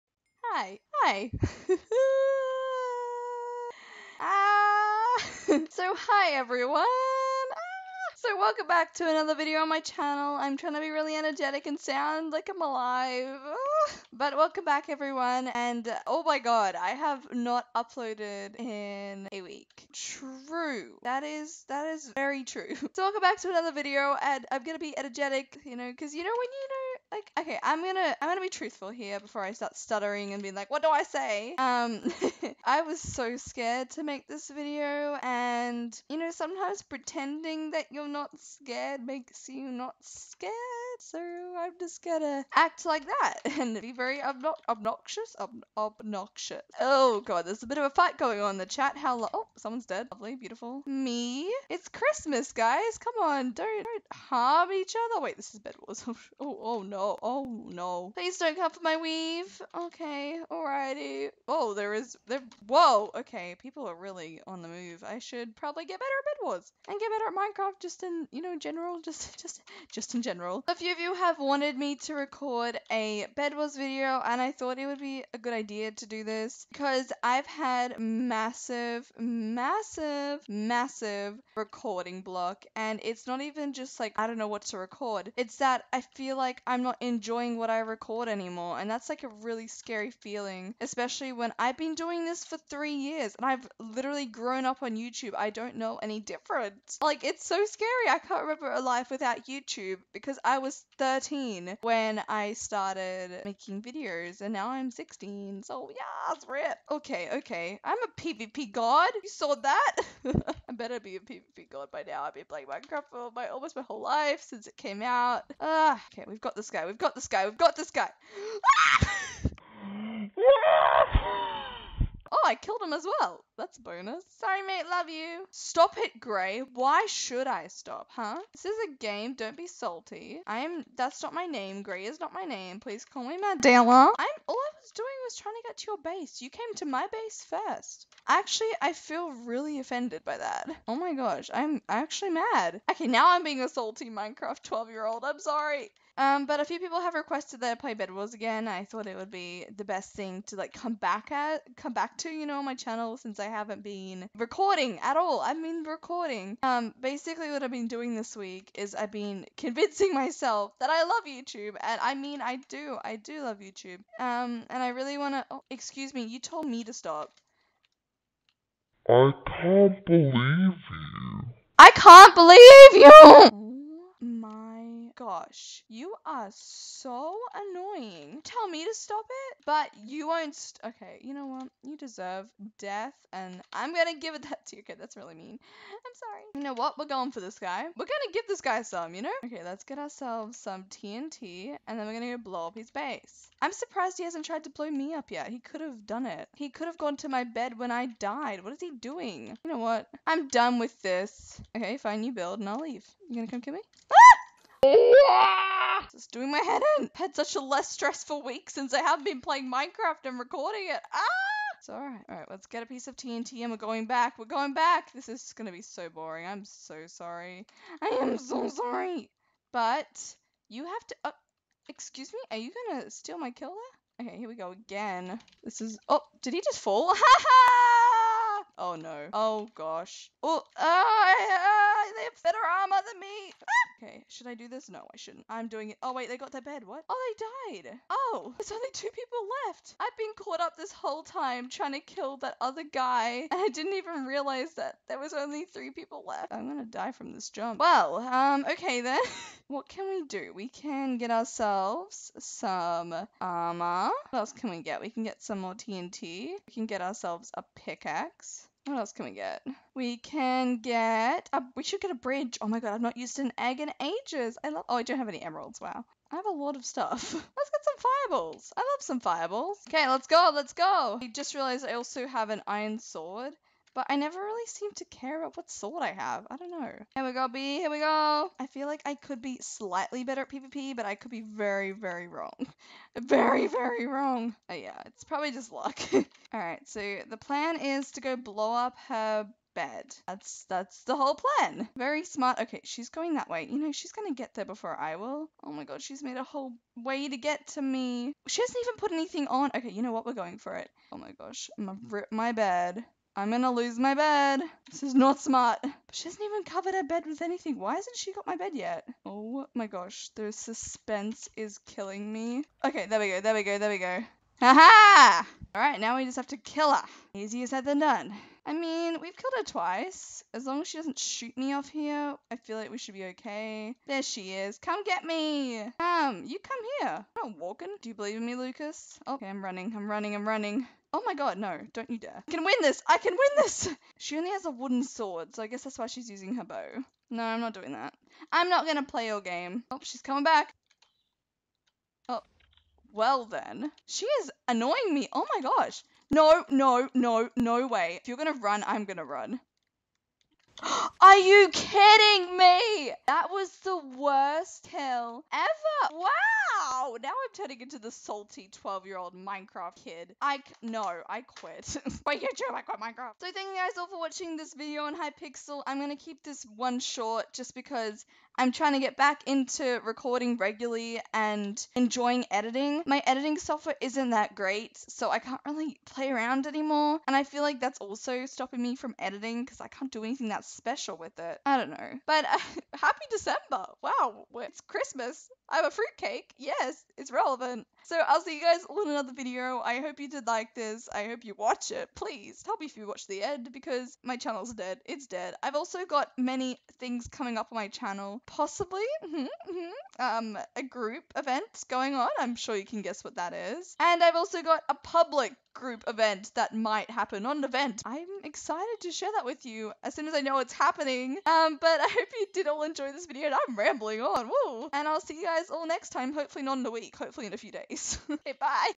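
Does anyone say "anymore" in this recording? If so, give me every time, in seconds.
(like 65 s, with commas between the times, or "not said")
88 s, 376 s.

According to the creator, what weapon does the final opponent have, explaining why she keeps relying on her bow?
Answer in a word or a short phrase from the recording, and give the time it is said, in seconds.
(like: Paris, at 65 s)
A wooden sword, at 334 s.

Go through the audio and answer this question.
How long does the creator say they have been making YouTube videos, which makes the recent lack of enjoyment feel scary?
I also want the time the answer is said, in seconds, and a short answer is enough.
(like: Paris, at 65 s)
3 years, at 92 s.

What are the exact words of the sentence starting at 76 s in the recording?
Because I've had massive, massive, massive recording block.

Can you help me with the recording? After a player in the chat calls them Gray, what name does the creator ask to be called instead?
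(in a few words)
Madella.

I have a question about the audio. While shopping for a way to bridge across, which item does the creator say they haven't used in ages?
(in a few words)
An egg.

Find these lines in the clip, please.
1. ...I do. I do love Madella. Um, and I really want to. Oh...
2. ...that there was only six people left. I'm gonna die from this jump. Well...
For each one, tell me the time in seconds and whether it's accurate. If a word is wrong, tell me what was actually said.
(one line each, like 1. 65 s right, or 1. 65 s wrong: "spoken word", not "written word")
1. 162 s wrong: "YouTube", not "Madella"
2. 244 s wrong: "three", not "six".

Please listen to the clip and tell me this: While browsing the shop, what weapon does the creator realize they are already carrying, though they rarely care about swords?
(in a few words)
An iron sword.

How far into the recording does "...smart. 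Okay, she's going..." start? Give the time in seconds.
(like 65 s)
292 s.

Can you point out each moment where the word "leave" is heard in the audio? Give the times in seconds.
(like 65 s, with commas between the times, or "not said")
202 s.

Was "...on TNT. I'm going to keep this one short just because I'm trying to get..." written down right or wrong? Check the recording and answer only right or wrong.
wrong.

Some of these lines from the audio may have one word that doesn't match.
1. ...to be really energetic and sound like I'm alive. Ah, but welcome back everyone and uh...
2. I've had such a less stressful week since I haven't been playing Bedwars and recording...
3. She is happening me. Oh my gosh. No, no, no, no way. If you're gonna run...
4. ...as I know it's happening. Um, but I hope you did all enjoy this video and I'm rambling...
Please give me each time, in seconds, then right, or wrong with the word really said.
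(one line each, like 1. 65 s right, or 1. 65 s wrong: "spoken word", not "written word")
1. 10 s right
2. 207 s wrong: "Minecraft", not "Bedwars"
3. 344 s wrong: "annoying", not "happening"
4. 410 s right.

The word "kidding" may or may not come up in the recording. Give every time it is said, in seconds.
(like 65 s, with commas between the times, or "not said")
351 s.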